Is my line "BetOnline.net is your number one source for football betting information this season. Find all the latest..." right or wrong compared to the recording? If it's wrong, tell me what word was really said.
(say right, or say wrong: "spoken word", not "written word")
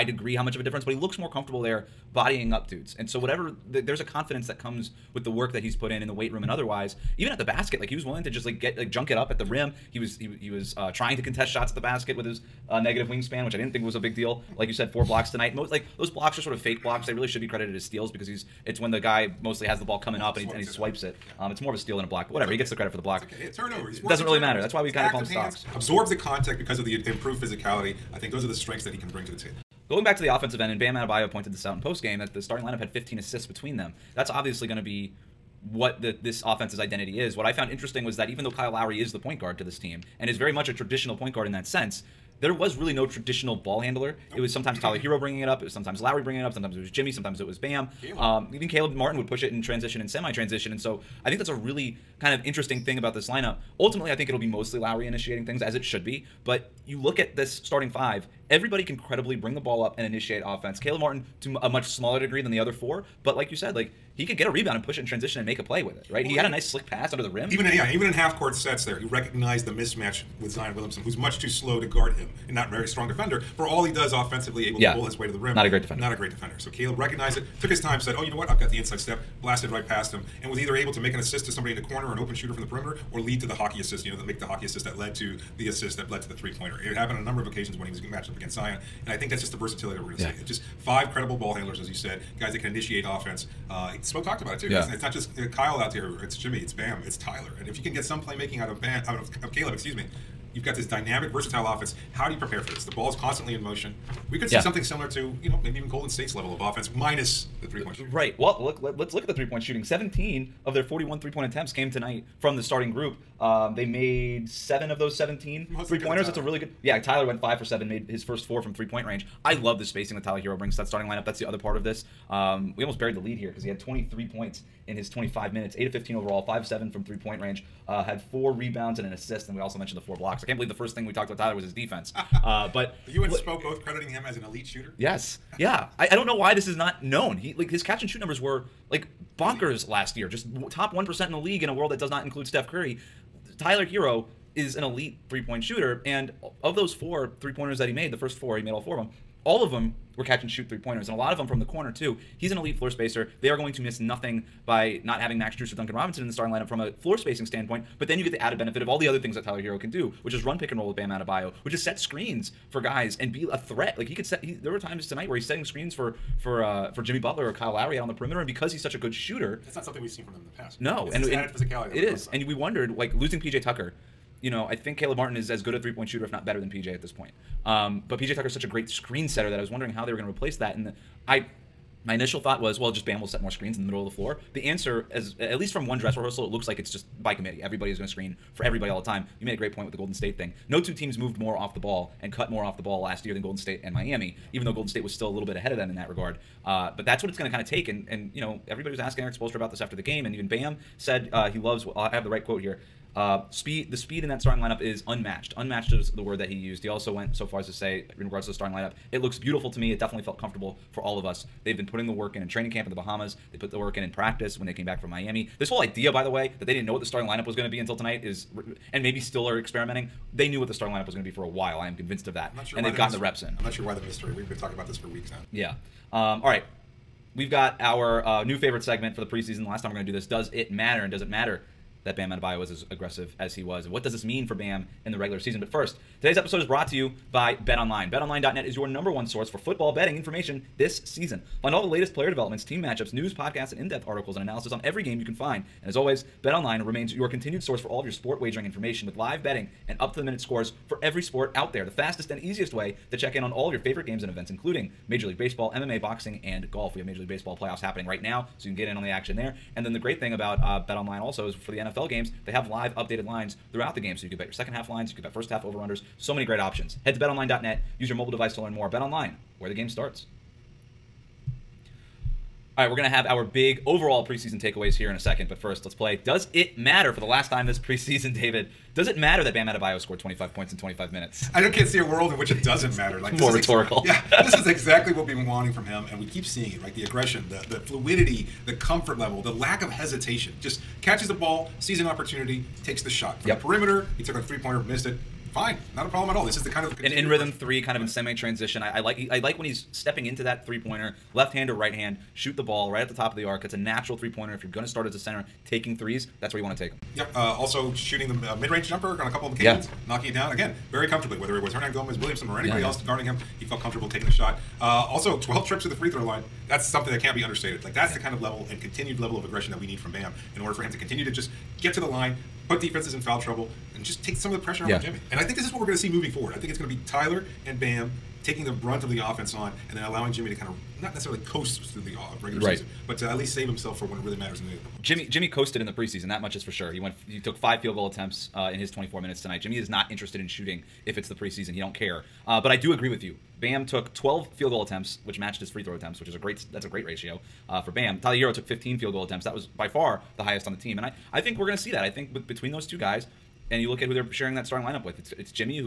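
right.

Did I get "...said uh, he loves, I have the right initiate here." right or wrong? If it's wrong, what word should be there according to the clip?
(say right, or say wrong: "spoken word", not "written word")
wrong: "quote", not "initiate".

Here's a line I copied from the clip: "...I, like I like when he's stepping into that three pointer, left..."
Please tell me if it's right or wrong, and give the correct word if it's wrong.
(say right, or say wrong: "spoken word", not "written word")
right.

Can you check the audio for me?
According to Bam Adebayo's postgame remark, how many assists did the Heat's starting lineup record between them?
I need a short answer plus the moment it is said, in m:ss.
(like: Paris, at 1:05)
15, at 0:32.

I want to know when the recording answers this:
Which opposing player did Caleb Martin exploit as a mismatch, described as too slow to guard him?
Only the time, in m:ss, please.
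1:10.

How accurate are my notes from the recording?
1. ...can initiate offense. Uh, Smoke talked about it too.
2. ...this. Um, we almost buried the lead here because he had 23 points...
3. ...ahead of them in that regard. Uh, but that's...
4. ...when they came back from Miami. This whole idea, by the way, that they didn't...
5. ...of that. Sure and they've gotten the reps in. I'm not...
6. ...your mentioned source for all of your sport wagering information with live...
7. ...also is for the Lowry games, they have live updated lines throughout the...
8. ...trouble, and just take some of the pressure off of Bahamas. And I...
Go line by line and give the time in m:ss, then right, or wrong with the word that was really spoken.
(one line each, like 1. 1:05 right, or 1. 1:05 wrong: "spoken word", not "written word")
1. 1:32 right
2. 2:01 right
3. 3:15 right
4. 3:34 right
5. 3:42 right
6. 4:07 wrong: "continued", not "mentioned"
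7. 4:21 wrong: "NFL", not "Lowry"
8. 5:23 wrong: "Jimmy", not "Bahamas".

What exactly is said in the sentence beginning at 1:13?
For all he does offensively, able yeah.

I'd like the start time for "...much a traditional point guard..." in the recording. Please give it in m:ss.
0:40.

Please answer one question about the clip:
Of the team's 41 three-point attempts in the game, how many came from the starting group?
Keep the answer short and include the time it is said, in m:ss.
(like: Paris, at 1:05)
17, at 1:49.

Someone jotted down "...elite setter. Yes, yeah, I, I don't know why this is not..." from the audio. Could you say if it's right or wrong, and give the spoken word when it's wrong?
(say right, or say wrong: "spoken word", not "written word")
wrong: "shooter", not "setter".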